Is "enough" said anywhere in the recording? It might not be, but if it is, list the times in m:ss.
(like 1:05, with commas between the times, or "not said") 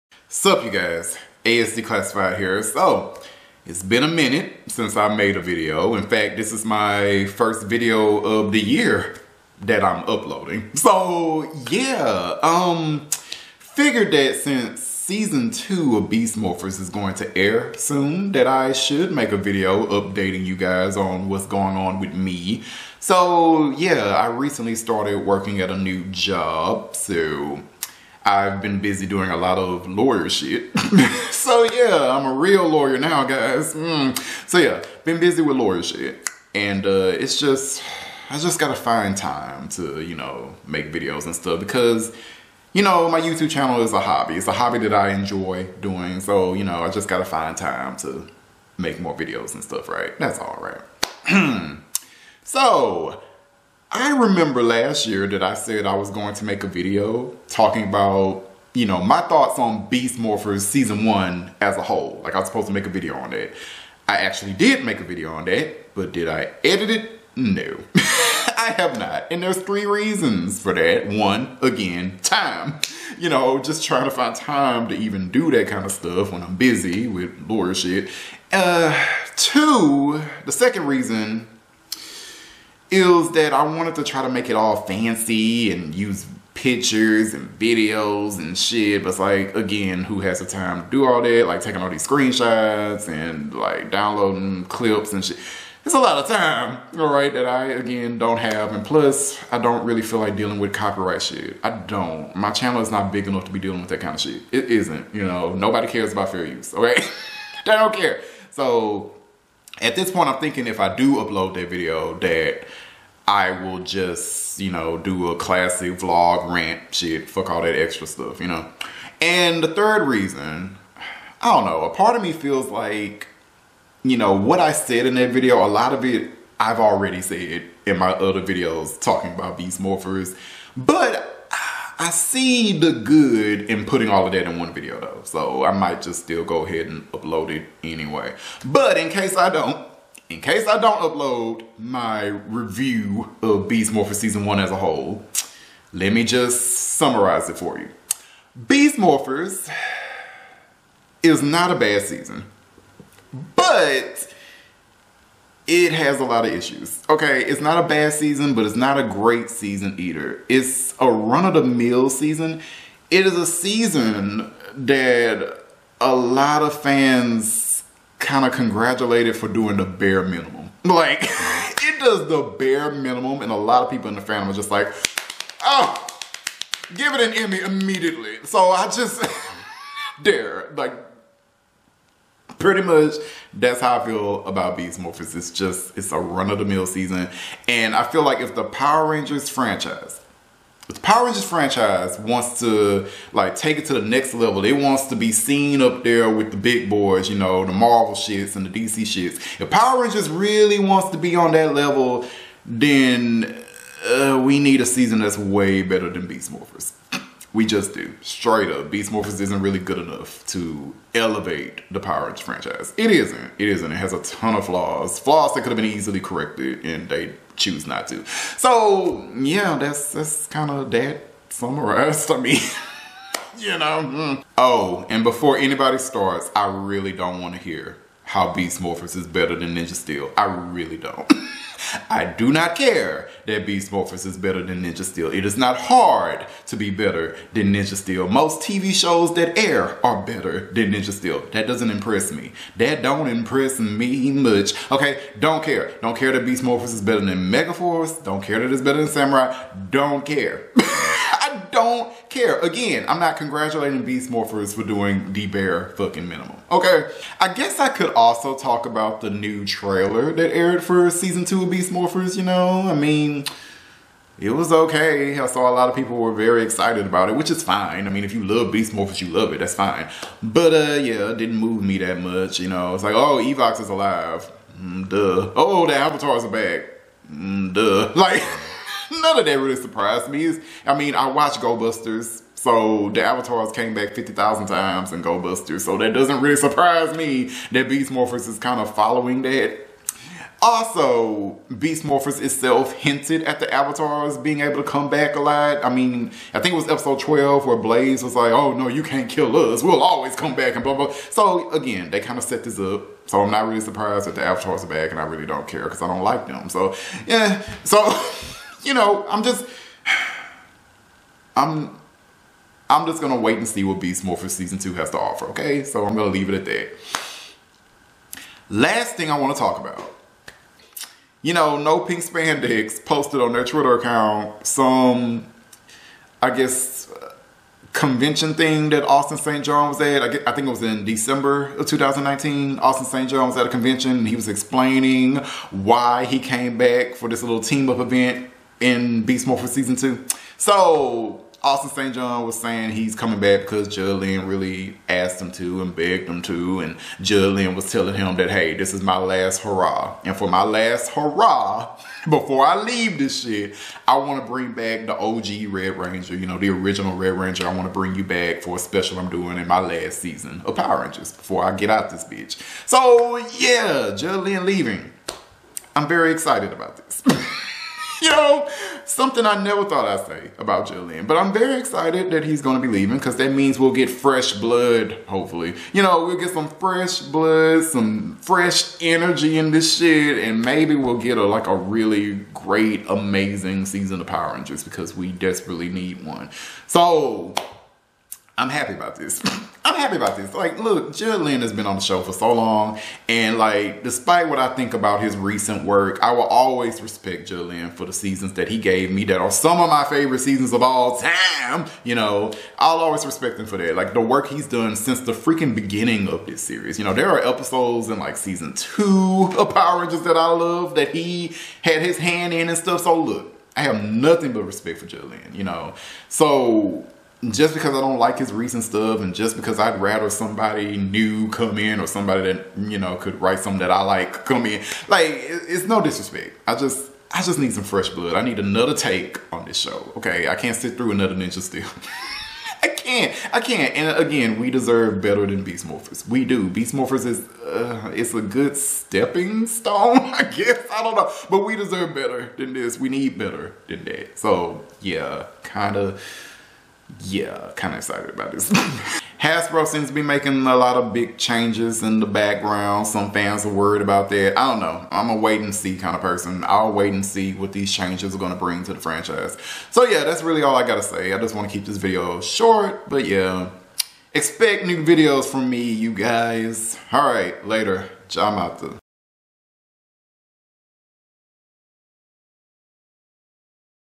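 1:43, 3:29.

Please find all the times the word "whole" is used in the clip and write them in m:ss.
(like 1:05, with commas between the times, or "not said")
1:01, 2:24.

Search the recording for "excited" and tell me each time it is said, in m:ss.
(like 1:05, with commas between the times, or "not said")
4:26, 6:06, 6:11, 7:27.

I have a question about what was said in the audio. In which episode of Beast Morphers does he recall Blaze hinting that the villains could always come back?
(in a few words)
episode 12.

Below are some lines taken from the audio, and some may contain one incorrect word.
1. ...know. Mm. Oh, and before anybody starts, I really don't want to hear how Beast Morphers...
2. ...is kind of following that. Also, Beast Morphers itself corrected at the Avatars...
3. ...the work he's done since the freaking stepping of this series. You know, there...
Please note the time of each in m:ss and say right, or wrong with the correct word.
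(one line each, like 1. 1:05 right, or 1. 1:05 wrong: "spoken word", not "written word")
1. 3:43 right
2. 4:48 wrong: "hinted", not "corrected"
3. 6:44 wrong: "beginning", not "stepping".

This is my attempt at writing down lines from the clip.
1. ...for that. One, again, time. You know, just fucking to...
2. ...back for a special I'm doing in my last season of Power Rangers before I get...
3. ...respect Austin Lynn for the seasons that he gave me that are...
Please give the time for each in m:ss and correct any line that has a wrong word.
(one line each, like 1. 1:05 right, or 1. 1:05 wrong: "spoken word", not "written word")
1. 1:10 wrong: "trying", not "fucking"
2. 5:58 right
3. 6:37 wrong: "Judd", not "Austin".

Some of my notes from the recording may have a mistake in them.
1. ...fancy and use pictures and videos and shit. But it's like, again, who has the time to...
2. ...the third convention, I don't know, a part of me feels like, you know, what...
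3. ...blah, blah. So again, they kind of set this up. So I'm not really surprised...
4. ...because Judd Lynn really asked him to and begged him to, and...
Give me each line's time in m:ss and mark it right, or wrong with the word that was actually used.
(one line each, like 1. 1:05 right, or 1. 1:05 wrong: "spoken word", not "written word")
1. 1:24 right
2. 1:59 wrong: "reason", not "convention"
3. 5:00 right
4. 5:43 right.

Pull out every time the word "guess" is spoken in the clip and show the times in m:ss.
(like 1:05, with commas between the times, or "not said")
4:17, 5:26, 7:20.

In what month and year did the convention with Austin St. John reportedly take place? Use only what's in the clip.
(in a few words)
December 2019.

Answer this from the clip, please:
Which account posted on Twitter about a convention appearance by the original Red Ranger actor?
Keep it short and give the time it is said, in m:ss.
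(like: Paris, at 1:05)
No Pink Spandex, at 5:21.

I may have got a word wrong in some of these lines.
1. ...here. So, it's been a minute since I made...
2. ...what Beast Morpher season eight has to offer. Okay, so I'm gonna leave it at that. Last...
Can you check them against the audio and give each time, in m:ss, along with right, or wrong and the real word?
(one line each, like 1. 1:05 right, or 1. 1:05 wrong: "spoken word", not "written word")
1. 0:02 right
2. 5:13 wrong: "two", not "eight".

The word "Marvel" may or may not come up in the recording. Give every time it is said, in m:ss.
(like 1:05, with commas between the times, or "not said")
3:17.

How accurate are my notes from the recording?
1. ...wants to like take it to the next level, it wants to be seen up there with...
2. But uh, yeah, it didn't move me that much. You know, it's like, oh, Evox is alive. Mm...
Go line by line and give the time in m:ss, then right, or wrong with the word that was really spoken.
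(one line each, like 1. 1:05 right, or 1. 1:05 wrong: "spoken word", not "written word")
1. 3:12 right
2. 4:30 right.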